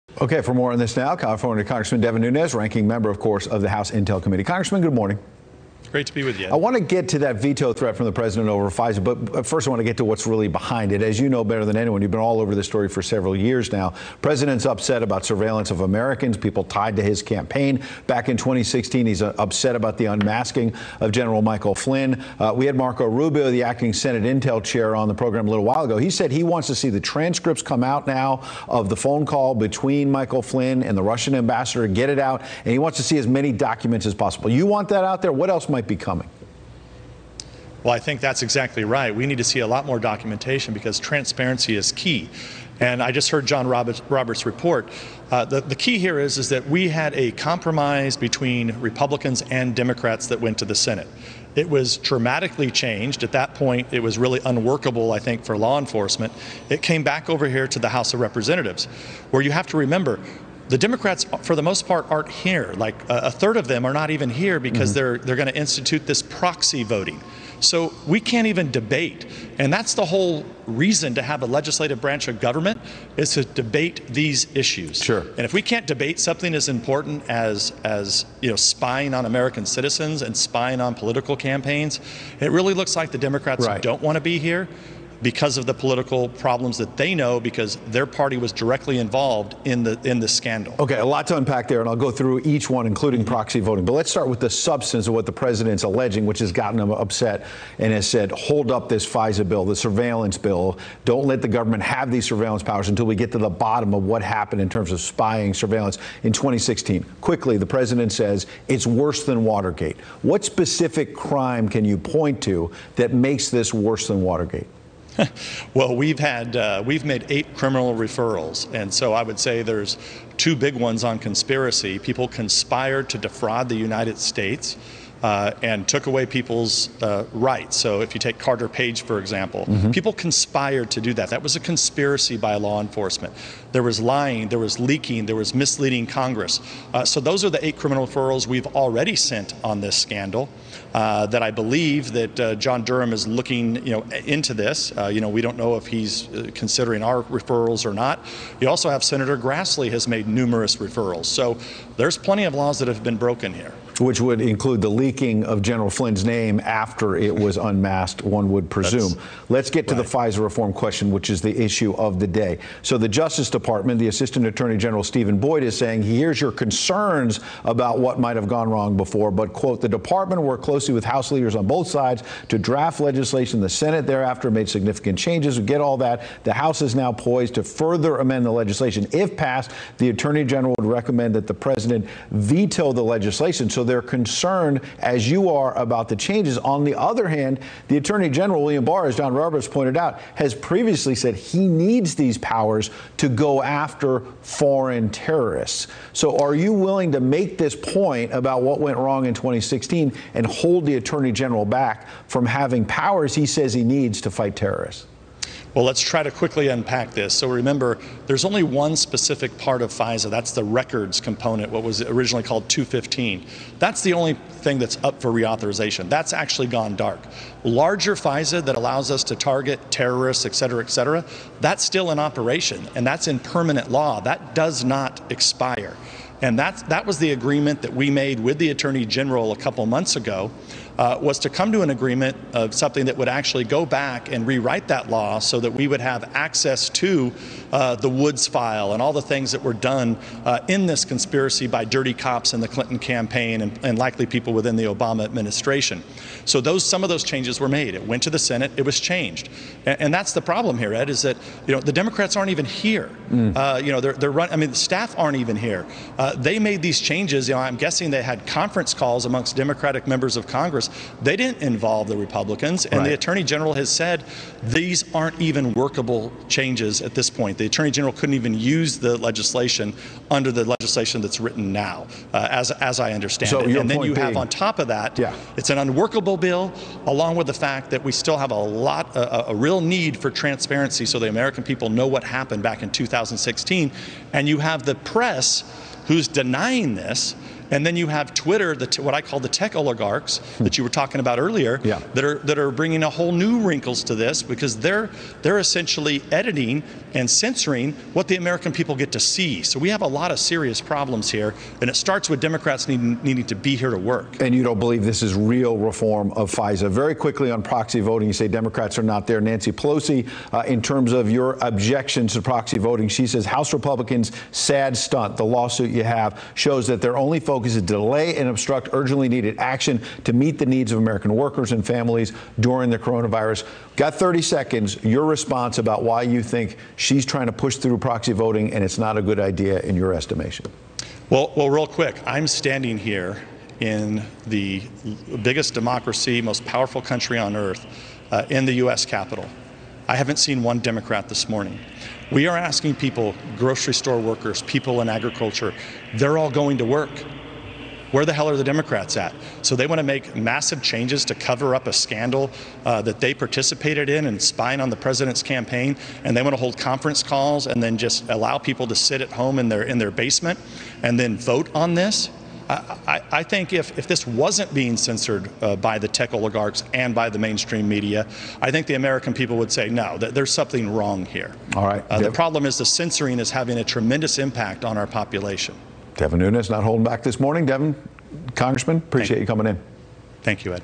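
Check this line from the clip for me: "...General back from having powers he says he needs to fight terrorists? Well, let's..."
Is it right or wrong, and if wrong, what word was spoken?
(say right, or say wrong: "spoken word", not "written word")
right.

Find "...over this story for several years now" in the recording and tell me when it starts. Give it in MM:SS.
00:12.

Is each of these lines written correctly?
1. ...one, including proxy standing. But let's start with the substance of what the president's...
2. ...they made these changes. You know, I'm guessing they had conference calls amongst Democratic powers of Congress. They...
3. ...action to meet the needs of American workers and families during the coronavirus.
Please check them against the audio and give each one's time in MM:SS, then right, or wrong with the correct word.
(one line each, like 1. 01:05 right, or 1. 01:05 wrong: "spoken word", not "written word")
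1. 01:32 wrong: "voting", not "standing"
2. 04:16 wrong: "members", not "powers"
3. 05:19 right.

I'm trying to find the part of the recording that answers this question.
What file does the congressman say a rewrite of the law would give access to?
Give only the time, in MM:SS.
03:58.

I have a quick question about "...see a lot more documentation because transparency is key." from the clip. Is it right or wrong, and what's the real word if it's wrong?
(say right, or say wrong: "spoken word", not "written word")
right.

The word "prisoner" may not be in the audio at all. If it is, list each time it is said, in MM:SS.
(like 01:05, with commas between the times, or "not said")
not said.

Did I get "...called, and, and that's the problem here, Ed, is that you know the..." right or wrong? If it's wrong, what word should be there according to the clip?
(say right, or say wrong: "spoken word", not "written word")
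wrong: "changed", not "called".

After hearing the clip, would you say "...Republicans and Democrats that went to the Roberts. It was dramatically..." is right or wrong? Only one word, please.
wrong.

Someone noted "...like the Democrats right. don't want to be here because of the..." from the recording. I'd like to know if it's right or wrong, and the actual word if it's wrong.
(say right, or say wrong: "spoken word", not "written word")
right.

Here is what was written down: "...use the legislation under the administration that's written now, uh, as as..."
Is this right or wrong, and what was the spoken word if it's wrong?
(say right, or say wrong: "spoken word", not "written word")
wrong: "legislation", not "administration".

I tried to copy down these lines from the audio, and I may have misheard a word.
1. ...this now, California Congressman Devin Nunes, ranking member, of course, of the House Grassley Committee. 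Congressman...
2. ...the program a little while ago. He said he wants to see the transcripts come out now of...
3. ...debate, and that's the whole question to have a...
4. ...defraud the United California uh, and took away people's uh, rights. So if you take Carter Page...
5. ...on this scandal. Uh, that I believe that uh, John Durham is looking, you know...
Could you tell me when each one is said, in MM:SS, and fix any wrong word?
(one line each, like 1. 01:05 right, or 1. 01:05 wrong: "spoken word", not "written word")
1. 00:00 wrong: "Intel", not "Grassley"
2. 00:25 right
3. 01:08 wrong: "reason", not "question"
4. 02:03 wrong: "States", not "California"
5. 02:19 right.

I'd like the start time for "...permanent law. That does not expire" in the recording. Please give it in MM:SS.
03:43.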